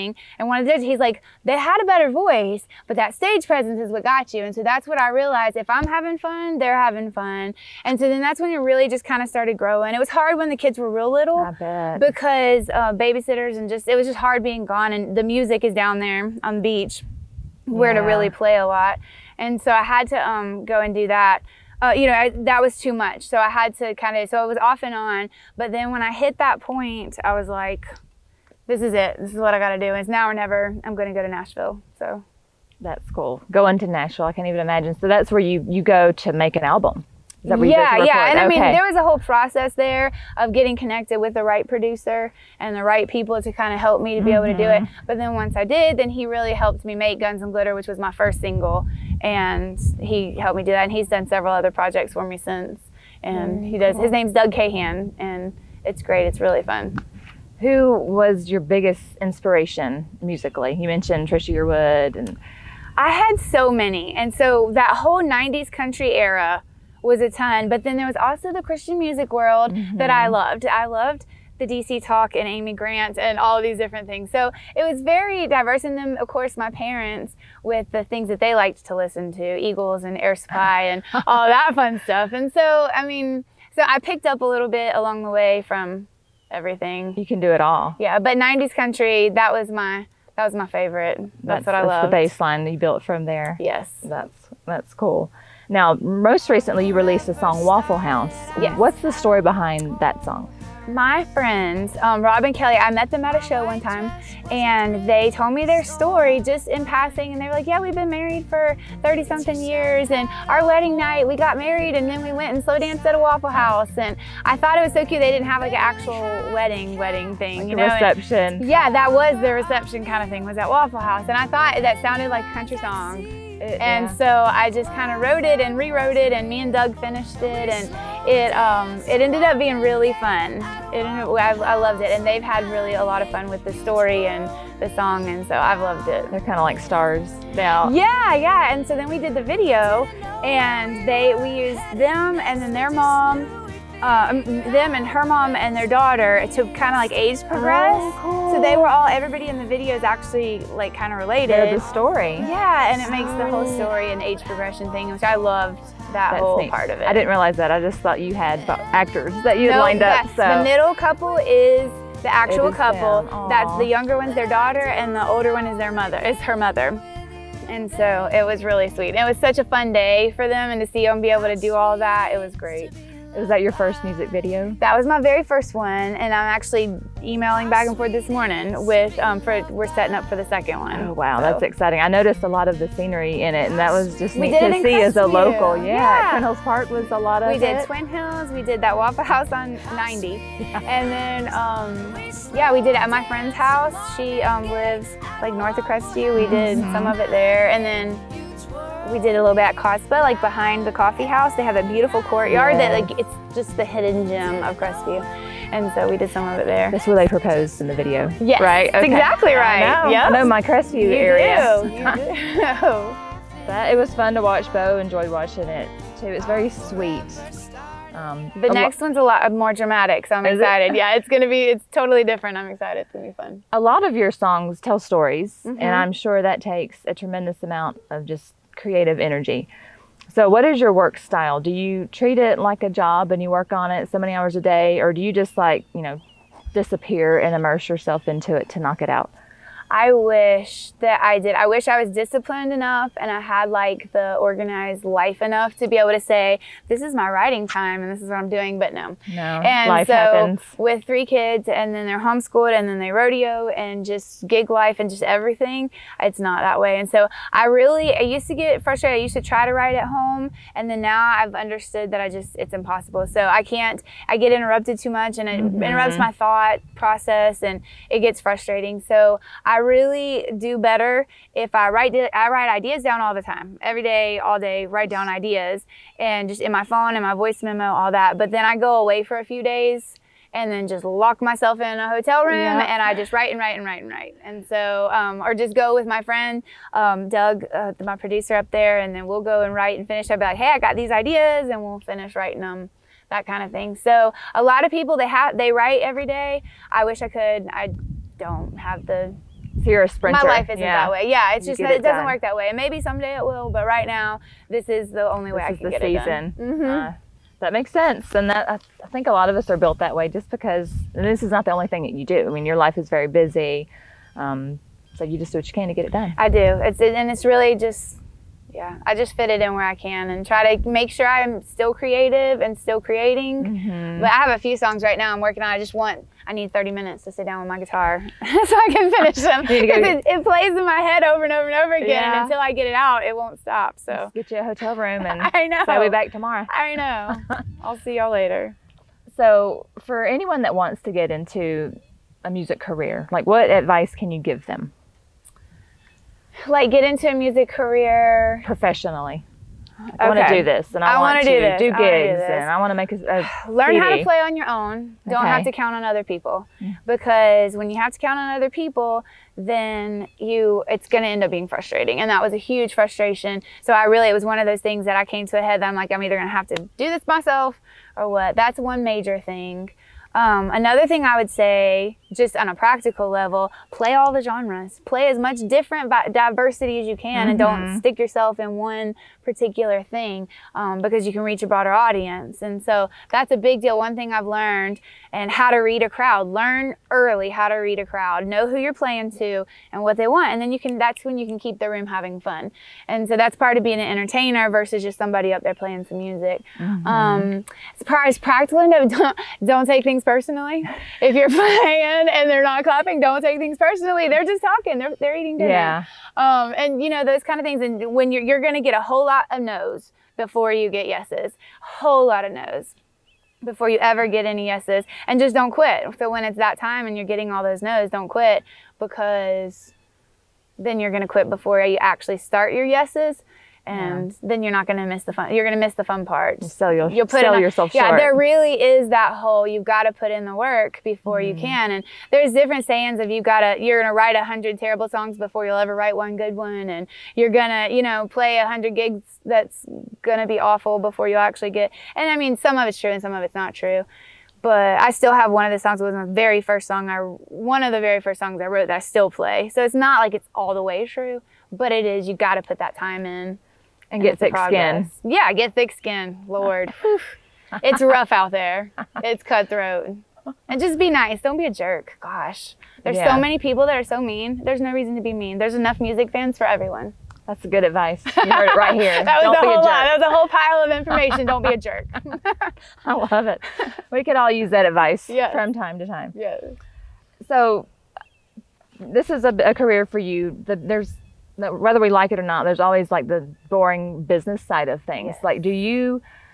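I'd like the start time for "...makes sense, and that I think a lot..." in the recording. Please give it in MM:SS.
05:07.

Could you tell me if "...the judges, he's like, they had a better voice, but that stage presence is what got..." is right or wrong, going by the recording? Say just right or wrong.
right.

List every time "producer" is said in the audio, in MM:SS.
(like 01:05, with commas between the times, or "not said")
00:41, 04:48.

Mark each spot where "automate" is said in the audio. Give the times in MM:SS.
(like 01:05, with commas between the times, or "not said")
not said.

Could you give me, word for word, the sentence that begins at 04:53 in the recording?
So a lot of people they have they write every day.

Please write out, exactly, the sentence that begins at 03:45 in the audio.
and I'm sure that takes a tremendous amount of just creative energy.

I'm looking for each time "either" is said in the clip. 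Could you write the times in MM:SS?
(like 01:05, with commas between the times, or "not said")
06:06.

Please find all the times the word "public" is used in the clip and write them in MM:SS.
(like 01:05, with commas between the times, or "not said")
not said.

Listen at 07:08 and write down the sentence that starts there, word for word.
Yeah, there really is that whole you've got to put in the work before mm.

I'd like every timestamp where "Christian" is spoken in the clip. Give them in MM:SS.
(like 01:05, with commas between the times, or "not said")
01:08.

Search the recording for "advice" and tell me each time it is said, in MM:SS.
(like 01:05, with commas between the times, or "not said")
05:43, 07:47, 07:54.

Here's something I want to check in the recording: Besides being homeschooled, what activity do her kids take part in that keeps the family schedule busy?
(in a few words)
Rodeo.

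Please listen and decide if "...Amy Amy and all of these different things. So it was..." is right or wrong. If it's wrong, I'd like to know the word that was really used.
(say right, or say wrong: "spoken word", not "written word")
wrong: "Grant", not "Amy".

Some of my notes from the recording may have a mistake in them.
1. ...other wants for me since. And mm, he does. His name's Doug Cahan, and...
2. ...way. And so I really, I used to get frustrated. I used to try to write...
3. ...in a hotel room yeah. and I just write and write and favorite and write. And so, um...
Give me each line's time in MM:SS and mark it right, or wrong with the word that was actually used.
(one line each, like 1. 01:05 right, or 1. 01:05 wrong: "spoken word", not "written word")
1. 00:51 wrong: "projects", not "wants"
2. 04:16 right
3. 04:41 wrong: "write", not "favorite".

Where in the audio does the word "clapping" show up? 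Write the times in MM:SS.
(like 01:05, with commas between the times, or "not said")
06:42.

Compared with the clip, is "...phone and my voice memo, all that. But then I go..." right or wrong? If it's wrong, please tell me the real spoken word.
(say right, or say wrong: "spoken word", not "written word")
right.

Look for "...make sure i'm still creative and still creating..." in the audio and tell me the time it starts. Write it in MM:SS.
05:20.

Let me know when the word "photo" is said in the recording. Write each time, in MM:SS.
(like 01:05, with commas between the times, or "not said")
not said.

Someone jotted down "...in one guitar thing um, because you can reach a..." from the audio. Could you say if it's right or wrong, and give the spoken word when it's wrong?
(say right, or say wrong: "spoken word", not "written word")
wrong: "particular", not "guitar".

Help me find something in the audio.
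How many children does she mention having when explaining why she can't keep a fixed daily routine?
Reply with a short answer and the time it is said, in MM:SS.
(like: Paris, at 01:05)
3, at 04:11.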